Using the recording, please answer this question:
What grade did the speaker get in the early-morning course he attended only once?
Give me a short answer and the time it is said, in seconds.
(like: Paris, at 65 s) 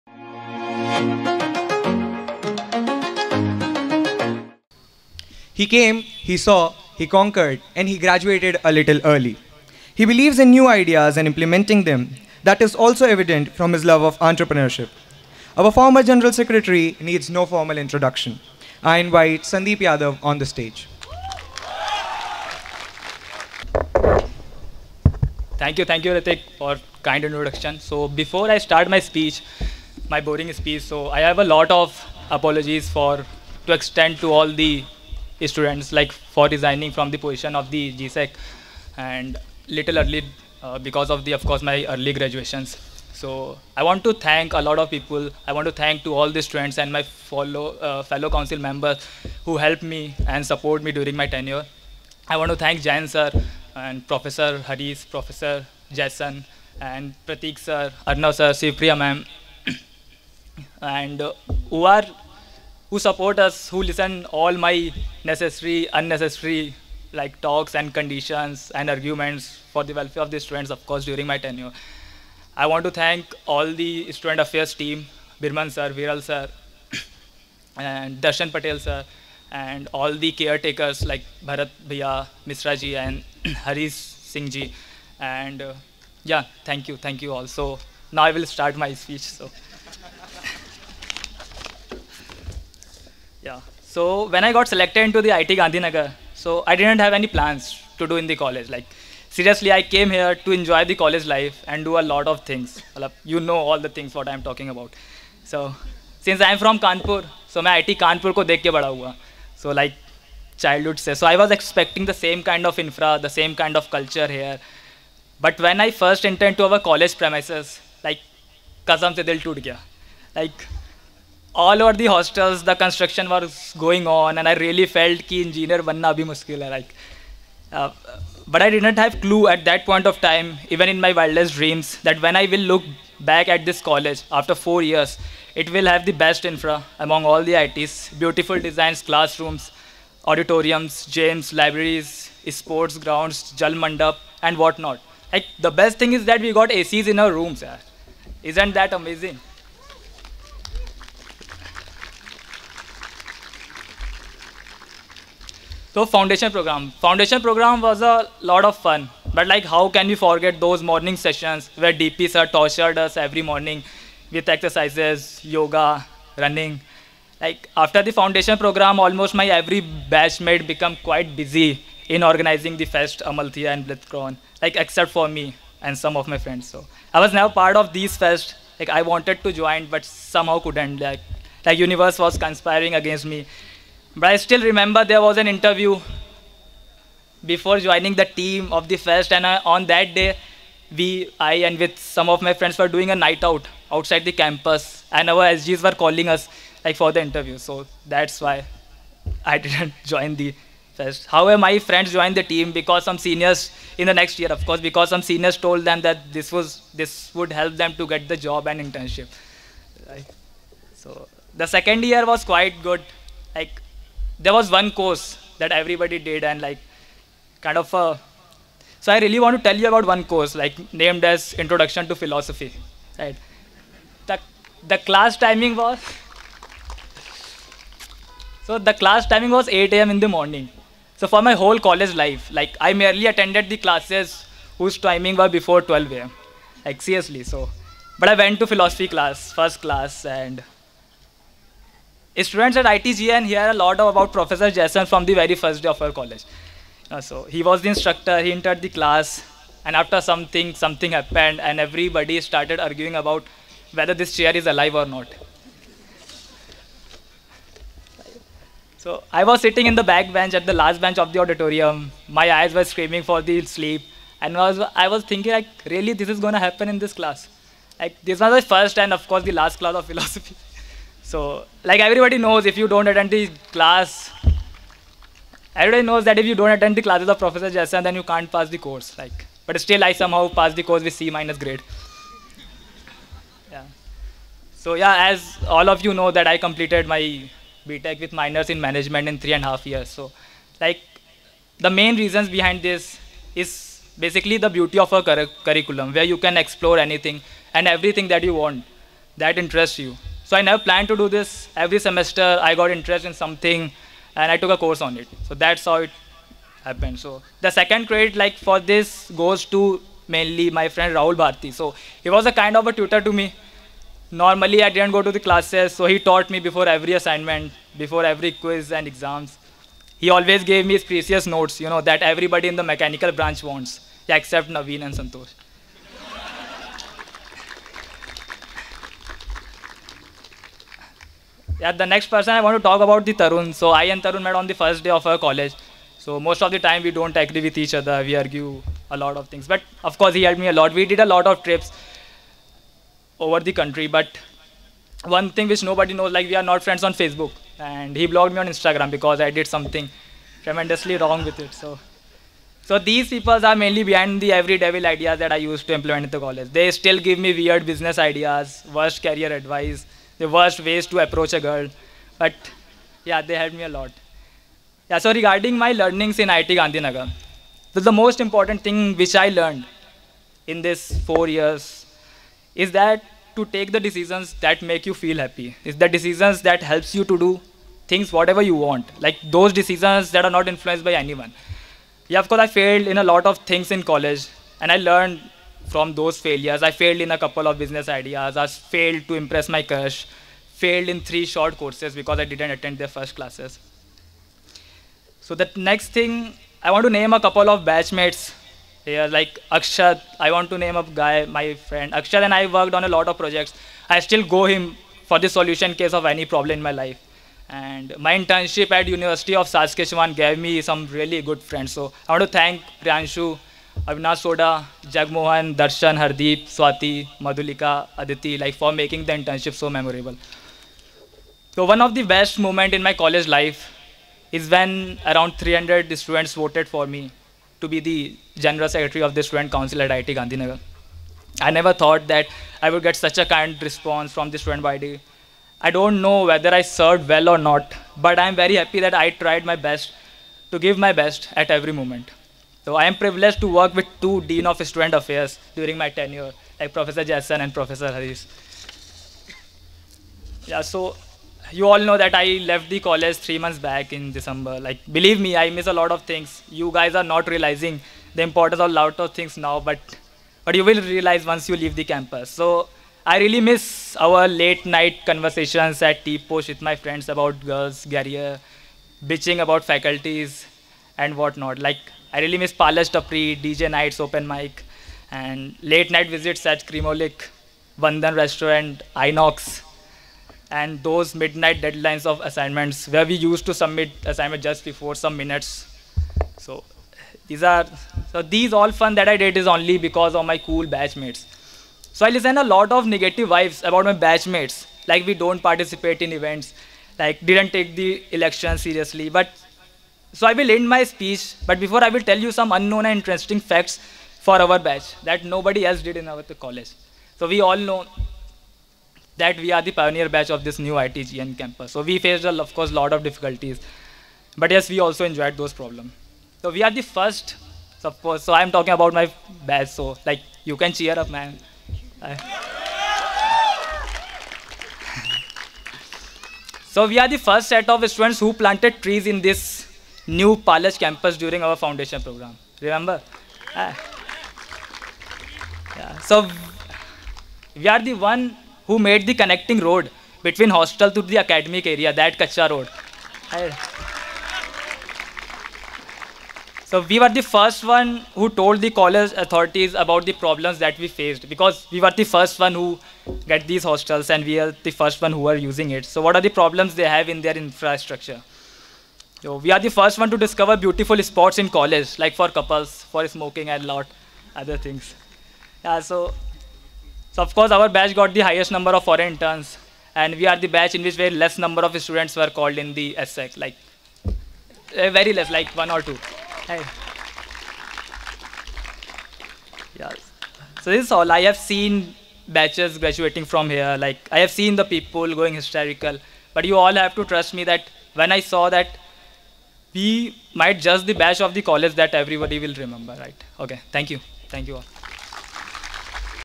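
C minus, at 281 s.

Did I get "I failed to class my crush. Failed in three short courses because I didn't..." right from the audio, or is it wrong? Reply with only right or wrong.
wrong.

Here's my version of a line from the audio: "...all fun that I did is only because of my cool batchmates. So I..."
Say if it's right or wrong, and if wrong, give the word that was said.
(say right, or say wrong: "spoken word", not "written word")
right.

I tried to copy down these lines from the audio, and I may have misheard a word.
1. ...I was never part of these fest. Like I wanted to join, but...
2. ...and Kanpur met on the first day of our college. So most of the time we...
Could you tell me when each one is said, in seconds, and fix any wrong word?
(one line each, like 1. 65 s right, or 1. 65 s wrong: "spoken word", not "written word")
1. 177 s right
2. 334 s wrong: "Tarun", not "Kanpur".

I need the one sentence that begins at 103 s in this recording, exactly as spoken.
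You know all the things what I'm talking about.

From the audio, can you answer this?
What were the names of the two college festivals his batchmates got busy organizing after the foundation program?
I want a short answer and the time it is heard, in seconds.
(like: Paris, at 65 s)
Amalthea and Blitzschlag, at 173 s.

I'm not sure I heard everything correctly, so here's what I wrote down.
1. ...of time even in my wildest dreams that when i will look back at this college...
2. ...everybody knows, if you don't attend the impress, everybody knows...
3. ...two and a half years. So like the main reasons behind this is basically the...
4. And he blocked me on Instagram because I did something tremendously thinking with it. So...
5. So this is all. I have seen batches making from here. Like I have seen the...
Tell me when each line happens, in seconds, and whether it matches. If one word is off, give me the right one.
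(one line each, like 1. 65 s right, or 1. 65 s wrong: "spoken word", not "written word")
1. 130 s right
2. 272 s wrong: "class", not "impress"
3. 289 s wrong: "three", not "two"
4. 347 s wrong: "wrong", not "thinking"
5. 580 s wrong: "graduating", not "making".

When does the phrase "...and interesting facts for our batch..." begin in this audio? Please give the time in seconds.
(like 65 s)
503 s.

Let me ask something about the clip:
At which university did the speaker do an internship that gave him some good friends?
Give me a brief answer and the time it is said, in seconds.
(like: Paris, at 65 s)
University of Saskatchewan, at 409 s.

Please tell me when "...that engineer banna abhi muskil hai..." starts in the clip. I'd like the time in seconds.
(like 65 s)
125 s.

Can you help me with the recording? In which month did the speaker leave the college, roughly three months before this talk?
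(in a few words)
December.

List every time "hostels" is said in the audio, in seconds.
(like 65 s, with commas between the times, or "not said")
122 s, 540 s, 553 s.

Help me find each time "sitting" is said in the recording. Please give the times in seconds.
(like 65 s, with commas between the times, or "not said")
259 s.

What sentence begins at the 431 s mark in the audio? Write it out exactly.
I never thought that I would get such a kind response from the student body.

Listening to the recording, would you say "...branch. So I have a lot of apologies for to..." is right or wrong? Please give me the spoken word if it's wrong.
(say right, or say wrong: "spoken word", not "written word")
wrong: "speech", not "branch".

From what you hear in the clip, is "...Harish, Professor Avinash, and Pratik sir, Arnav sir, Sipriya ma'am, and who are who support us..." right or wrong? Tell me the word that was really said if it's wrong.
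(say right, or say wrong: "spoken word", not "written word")
wrong: "Jason", not "Avinash".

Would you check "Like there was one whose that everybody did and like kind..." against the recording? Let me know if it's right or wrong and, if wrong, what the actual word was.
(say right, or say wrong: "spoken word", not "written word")
wrong: "course", not "whose".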